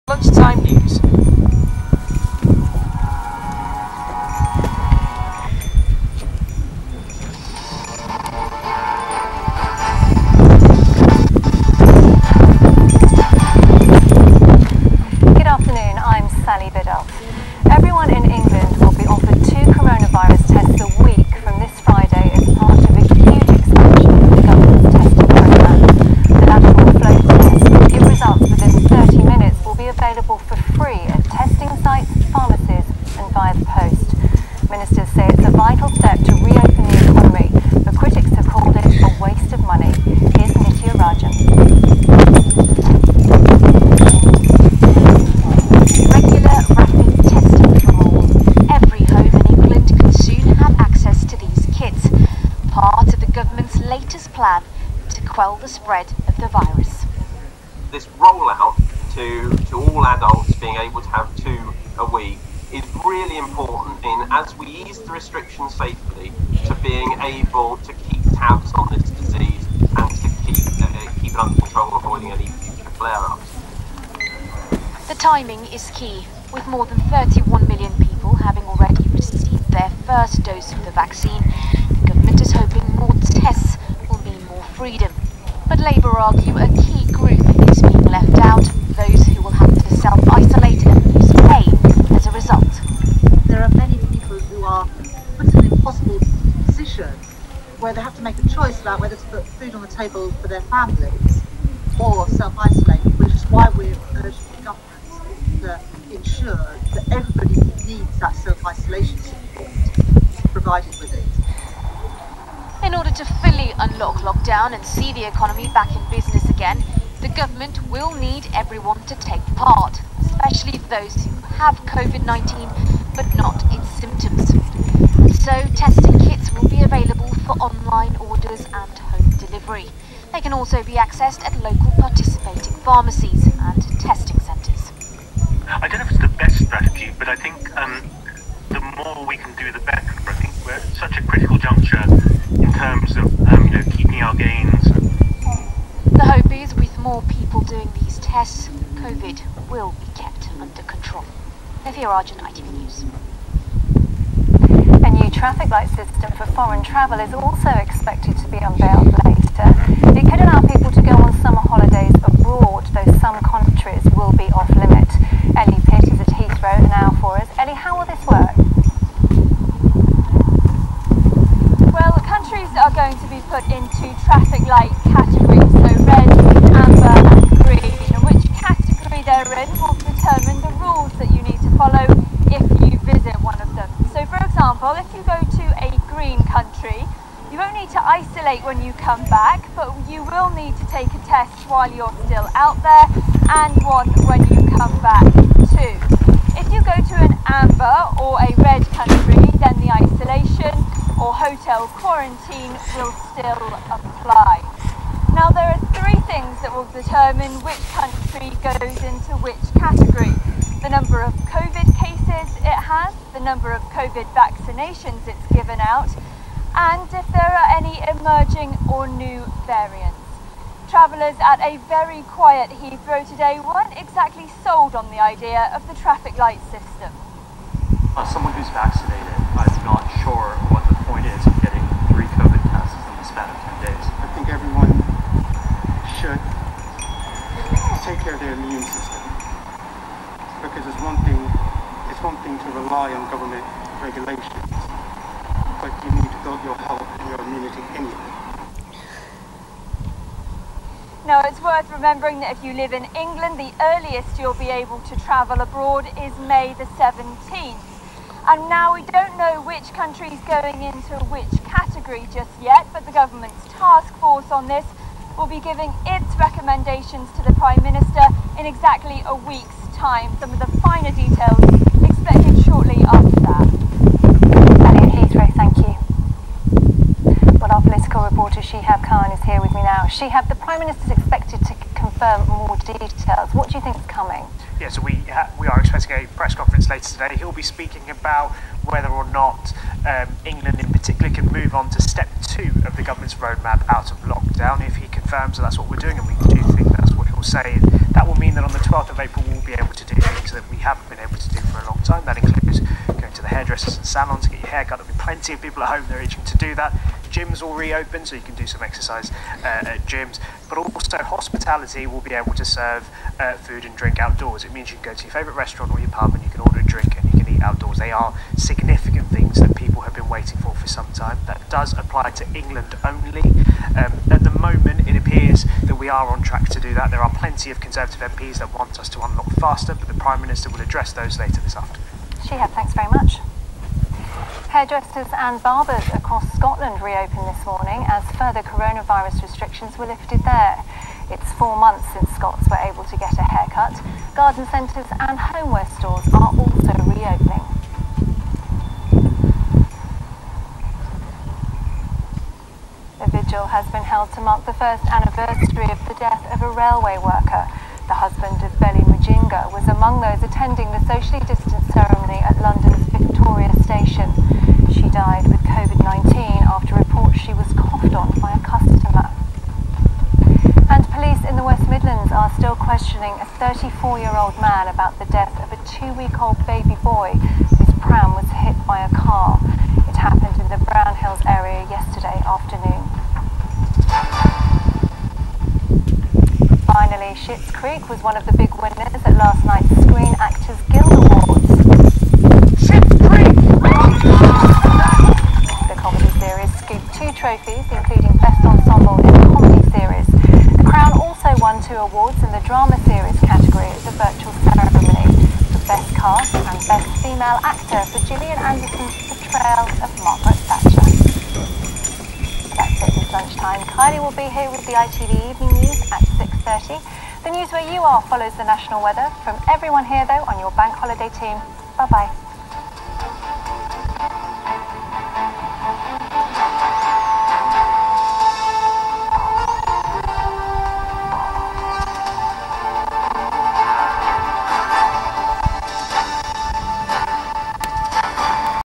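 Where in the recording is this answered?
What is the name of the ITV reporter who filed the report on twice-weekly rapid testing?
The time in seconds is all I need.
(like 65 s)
151 s.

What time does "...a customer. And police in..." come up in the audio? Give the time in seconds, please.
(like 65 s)
368 s.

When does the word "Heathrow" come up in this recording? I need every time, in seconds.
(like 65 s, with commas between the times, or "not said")
222 s, 275 s.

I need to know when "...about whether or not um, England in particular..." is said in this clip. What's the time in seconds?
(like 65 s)
288 s.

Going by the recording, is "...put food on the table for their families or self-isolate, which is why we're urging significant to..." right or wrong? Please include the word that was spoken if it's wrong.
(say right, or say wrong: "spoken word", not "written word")
wrong: "government", not "significant".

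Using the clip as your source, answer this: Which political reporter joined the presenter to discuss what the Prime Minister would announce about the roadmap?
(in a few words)
Shehab Khan.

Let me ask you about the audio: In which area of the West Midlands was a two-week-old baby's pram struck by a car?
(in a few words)
Brownhills.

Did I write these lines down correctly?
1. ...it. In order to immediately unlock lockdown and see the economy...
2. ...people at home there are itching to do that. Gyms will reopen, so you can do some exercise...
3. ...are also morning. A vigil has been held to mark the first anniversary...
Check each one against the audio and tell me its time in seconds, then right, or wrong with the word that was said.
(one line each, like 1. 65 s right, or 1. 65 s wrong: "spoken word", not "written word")
1. 111 s wrong: "fully", not "immediately"
2. 305 s right
3. 346 s wrong: "reopening", not "morning".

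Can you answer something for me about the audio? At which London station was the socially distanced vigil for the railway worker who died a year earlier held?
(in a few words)
Victoria Station.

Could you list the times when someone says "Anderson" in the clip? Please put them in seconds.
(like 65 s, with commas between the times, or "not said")
408 s.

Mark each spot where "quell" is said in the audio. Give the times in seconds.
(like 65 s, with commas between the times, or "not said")
55 s.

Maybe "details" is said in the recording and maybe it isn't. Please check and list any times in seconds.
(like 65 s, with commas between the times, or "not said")
271 s, 282 s.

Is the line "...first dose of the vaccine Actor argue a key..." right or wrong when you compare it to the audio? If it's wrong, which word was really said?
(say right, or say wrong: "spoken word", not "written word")
wrong: "Labour", not "Actor".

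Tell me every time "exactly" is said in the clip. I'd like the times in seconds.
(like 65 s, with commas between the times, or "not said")
223 s, 268 s.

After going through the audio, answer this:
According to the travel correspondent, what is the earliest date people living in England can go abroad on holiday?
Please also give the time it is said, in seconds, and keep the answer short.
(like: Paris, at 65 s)
May 17, at 256 s.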